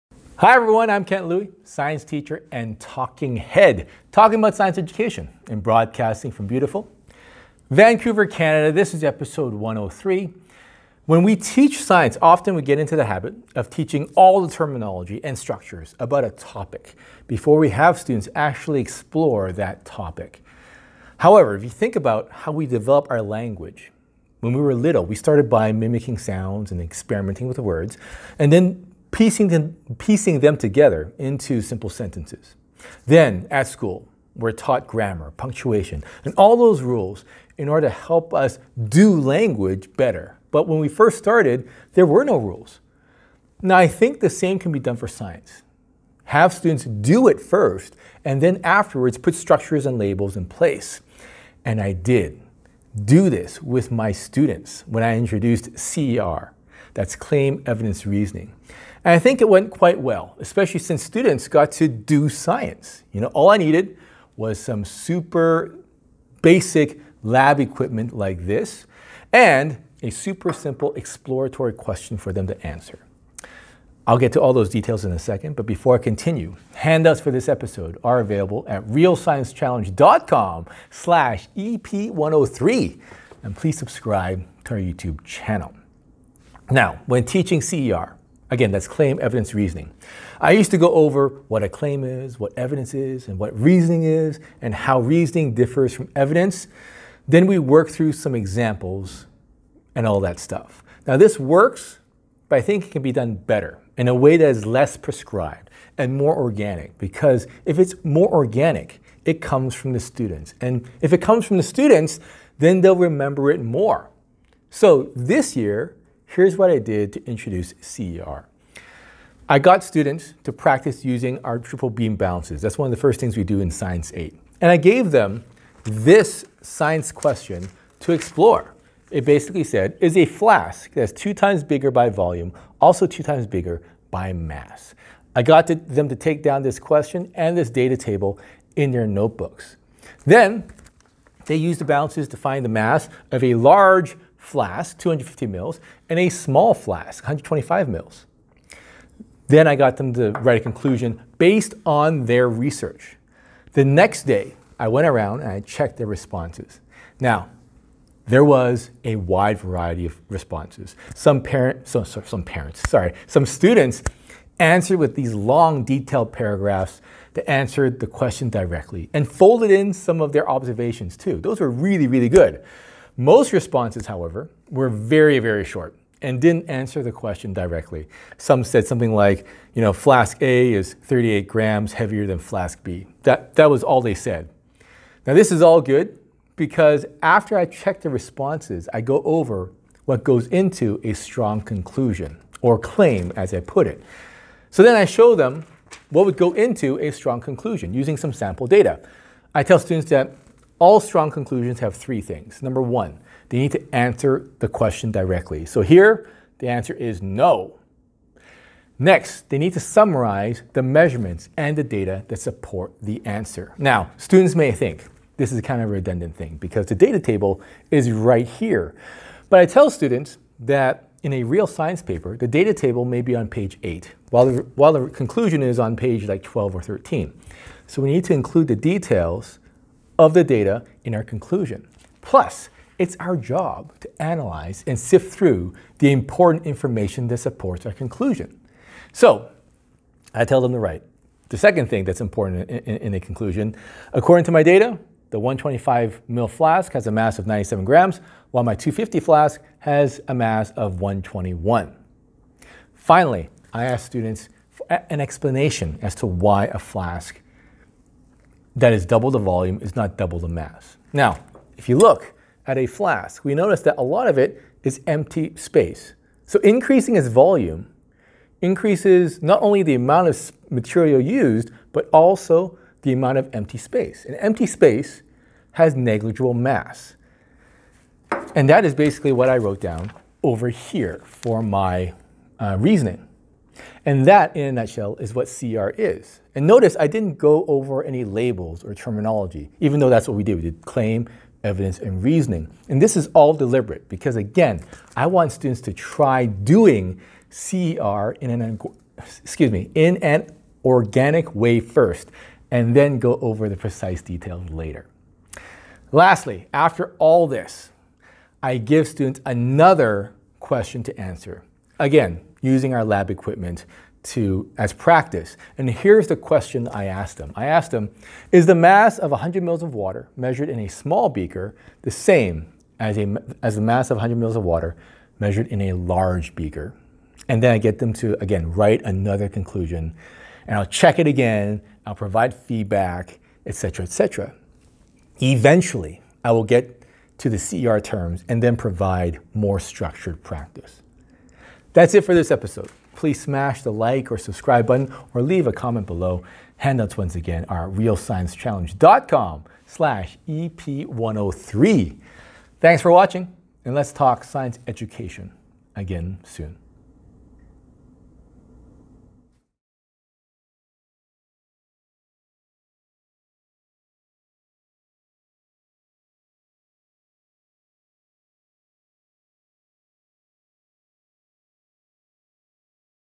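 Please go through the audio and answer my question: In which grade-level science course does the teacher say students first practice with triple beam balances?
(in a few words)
Science 8.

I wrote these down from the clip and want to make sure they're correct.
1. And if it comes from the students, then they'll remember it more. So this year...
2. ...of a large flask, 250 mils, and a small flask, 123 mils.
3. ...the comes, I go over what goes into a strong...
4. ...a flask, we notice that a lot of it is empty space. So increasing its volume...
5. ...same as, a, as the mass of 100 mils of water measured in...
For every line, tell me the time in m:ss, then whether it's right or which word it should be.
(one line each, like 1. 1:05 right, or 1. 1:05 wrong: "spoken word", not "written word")
1. 1:50 right
2. 2:23 wrong: "125", not "123"
3. 3:08 wrong: "responses", not "comes"
4. 4:22 right
5. 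5:22 right.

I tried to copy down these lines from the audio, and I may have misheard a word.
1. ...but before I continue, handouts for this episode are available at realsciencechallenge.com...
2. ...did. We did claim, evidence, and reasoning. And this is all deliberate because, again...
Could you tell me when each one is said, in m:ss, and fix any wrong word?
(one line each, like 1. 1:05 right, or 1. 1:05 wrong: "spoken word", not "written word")
1. 1:15 right
2. 4:50 right.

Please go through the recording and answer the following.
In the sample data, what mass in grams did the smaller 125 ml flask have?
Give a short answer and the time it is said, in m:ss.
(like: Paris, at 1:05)
97 grams, at 4:07.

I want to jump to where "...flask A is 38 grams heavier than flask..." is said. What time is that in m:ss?
2:59.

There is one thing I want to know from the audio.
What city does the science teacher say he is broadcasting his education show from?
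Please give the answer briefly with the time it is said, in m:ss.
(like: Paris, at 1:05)
Vancouver, at 0:07.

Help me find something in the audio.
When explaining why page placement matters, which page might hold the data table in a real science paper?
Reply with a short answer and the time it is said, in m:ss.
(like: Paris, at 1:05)
page 8, at 3:43.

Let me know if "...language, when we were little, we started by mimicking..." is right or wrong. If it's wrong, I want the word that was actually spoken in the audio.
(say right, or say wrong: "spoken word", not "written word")
right.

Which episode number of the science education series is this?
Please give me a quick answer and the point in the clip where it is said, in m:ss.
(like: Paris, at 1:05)
103, at 0:09.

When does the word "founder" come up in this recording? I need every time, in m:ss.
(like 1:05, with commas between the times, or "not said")
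not said.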